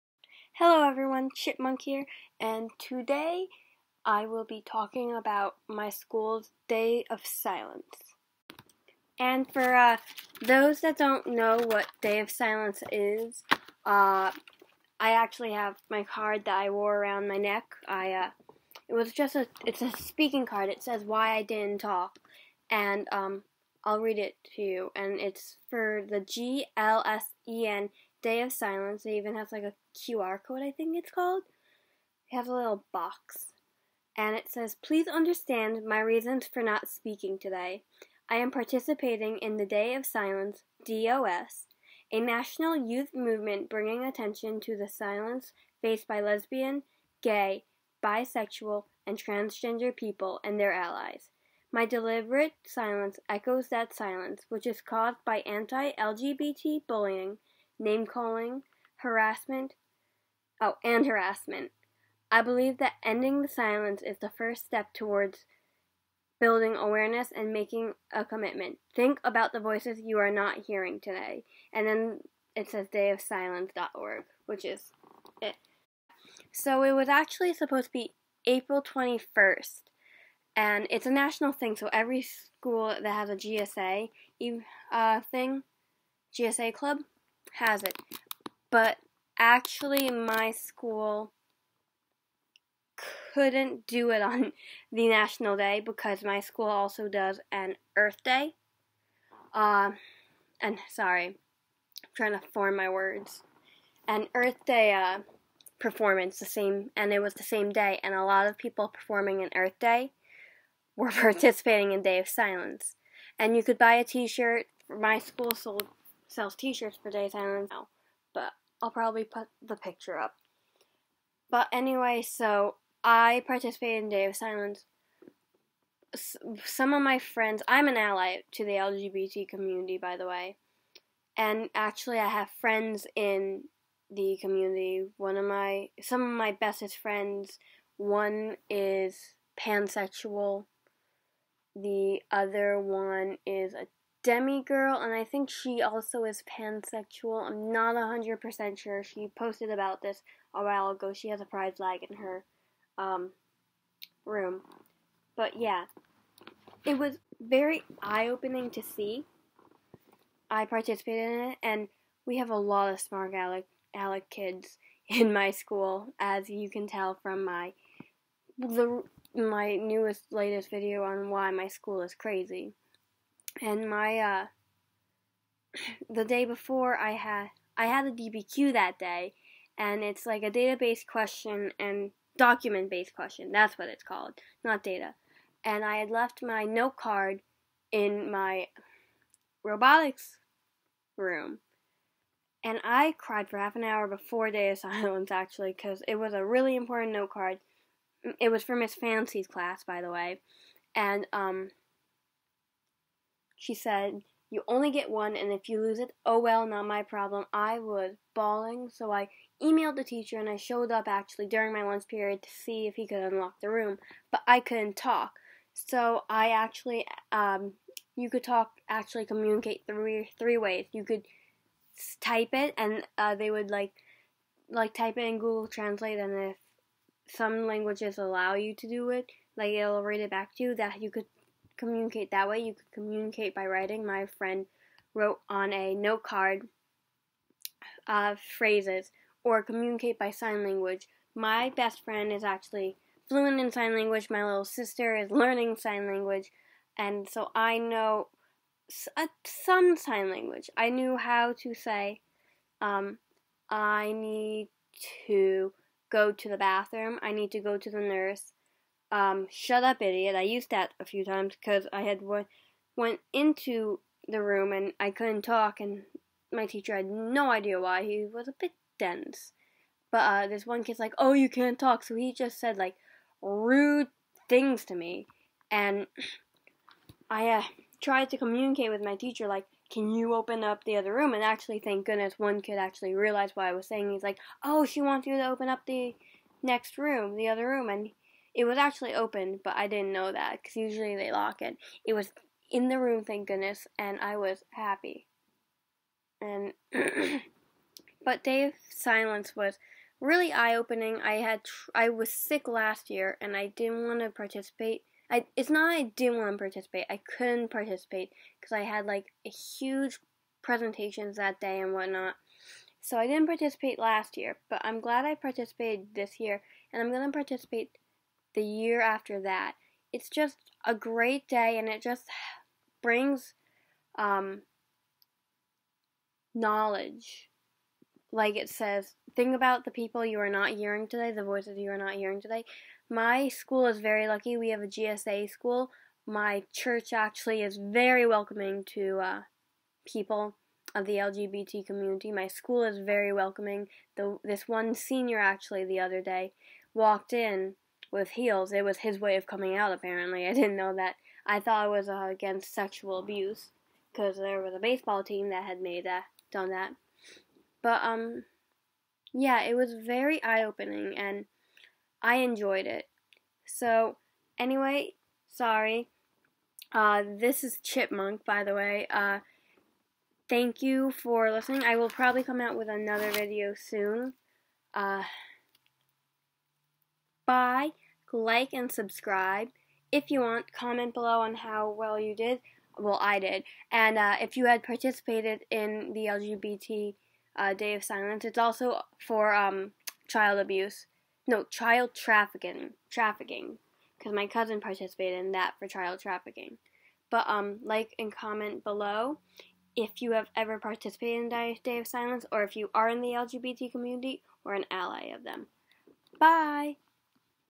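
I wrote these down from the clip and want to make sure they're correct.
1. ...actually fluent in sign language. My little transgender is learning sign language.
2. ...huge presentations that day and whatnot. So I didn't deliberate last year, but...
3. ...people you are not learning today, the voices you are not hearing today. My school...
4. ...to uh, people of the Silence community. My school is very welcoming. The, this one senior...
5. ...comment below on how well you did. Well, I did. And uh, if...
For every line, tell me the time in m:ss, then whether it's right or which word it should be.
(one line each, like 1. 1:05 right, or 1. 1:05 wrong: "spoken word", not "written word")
1. 4:02 wrong: "sister", not "transgender"
2. 5:09 wrong: "participate", not "deliberate"
3. 5:29 wrong: "hearing", not "learning"
4. 5:38 wrong: "LGBT", not "Silence"
5. 6:20 right.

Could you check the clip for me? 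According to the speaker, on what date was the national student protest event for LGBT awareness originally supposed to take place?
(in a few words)
April 21st.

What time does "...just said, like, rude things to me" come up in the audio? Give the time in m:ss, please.
4:32.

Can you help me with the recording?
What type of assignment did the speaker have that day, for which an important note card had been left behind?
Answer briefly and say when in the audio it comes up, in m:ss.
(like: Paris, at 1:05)
DBQ, at 2:58.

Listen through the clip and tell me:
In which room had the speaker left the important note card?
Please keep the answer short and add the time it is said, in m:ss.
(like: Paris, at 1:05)
robotics room, at 3:09.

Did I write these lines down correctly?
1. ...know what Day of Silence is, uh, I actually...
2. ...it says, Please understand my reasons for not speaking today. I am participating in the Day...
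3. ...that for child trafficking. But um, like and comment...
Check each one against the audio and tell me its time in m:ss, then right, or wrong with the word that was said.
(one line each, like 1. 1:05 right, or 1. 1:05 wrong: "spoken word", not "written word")
1. 0:11 right
2. 0:34 right
3. 6:35 right.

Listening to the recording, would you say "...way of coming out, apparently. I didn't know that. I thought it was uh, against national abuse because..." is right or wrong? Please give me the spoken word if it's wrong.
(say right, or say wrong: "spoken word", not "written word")
wrong: "sexual", not "national".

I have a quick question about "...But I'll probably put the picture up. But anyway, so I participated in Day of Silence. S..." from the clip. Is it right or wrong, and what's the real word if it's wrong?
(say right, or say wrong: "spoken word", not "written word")
right.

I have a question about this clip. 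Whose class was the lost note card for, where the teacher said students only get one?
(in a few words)
Miss Fancy.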